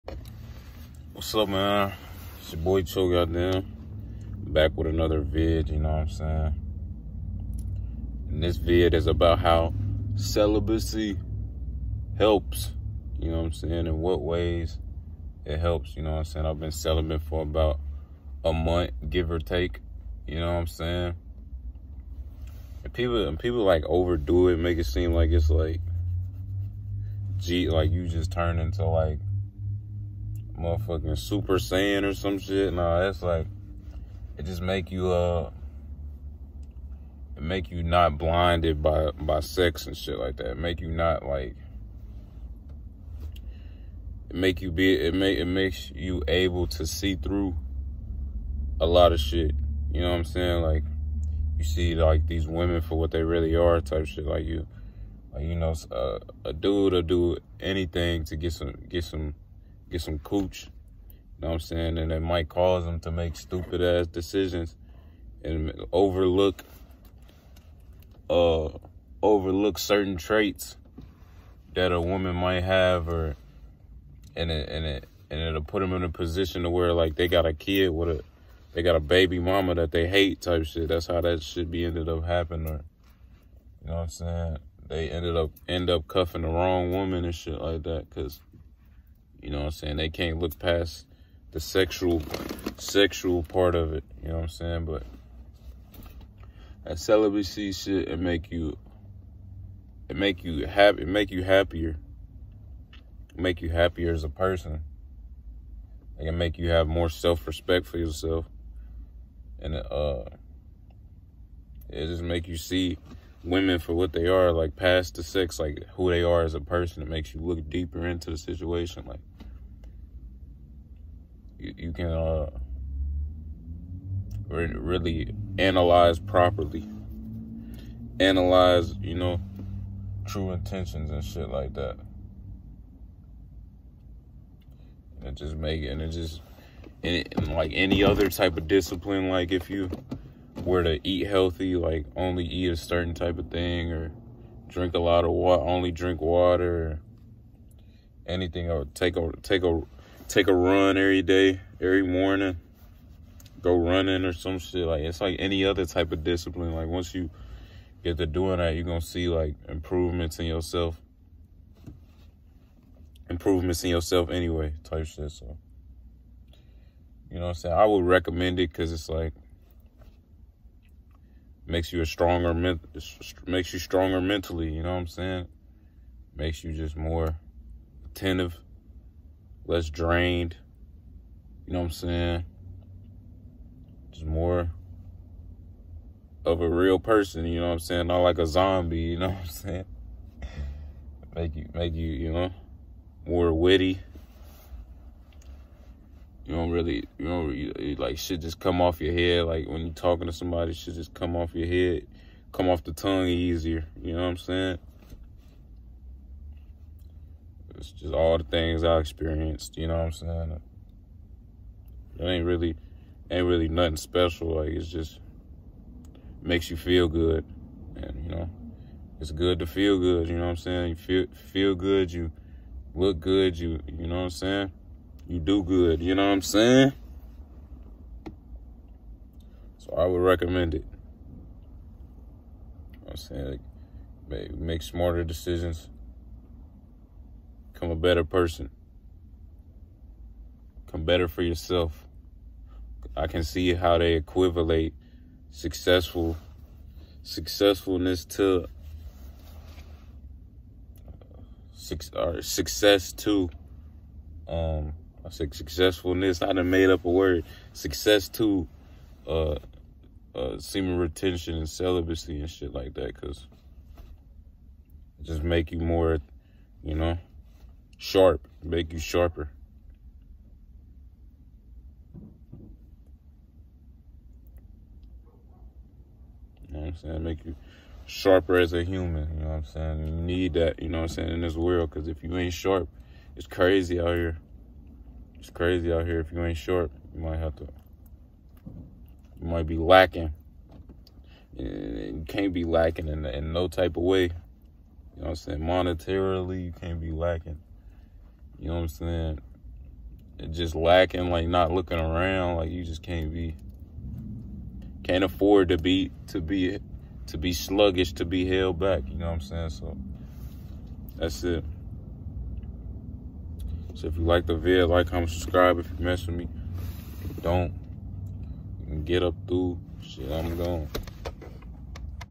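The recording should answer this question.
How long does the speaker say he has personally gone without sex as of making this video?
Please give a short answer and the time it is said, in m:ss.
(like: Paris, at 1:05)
about a month, at 0:17.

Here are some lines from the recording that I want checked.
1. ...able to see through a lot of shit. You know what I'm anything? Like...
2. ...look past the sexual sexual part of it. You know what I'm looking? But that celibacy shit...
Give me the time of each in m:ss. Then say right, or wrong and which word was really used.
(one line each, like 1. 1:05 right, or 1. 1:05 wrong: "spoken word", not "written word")
1. 0:46 wrong: "saying", not "anything"
2. 1:30 wrong: "saying", not "looking".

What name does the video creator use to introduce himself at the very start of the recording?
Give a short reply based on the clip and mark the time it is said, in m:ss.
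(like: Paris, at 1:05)
Choke, at 0:02.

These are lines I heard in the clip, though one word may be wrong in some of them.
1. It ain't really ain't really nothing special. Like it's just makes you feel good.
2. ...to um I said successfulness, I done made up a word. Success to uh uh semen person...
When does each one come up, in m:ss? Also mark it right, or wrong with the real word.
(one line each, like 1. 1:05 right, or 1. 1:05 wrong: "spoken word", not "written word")
1. 3:32 right
2. 4:13 wrong: "retention", not "person".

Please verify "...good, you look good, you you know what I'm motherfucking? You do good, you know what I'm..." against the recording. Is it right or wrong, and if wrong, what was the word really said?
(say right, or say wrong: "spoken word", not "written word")
wrong: "saying", not "motherfucking".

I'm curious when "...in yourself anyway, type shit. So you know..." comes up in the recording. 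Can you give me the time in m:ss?
2:43.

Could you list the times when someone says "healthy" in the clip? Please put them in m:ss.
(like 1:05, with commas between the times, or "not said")
2:21.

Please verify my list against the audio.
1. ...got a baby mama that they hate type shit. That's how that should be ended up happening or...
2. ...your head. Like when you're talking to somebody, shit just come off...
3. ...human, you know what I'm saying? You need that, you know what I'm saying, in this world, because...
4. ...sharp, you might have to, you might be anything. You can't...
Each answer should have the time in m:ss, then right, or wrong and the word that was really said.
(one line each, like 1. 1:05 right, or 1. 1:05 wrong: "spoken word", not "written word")
1. 1:18 right
2. 3:18 right
3. 4:38 right
4. 4:46 wrong: "lacking", not "anything".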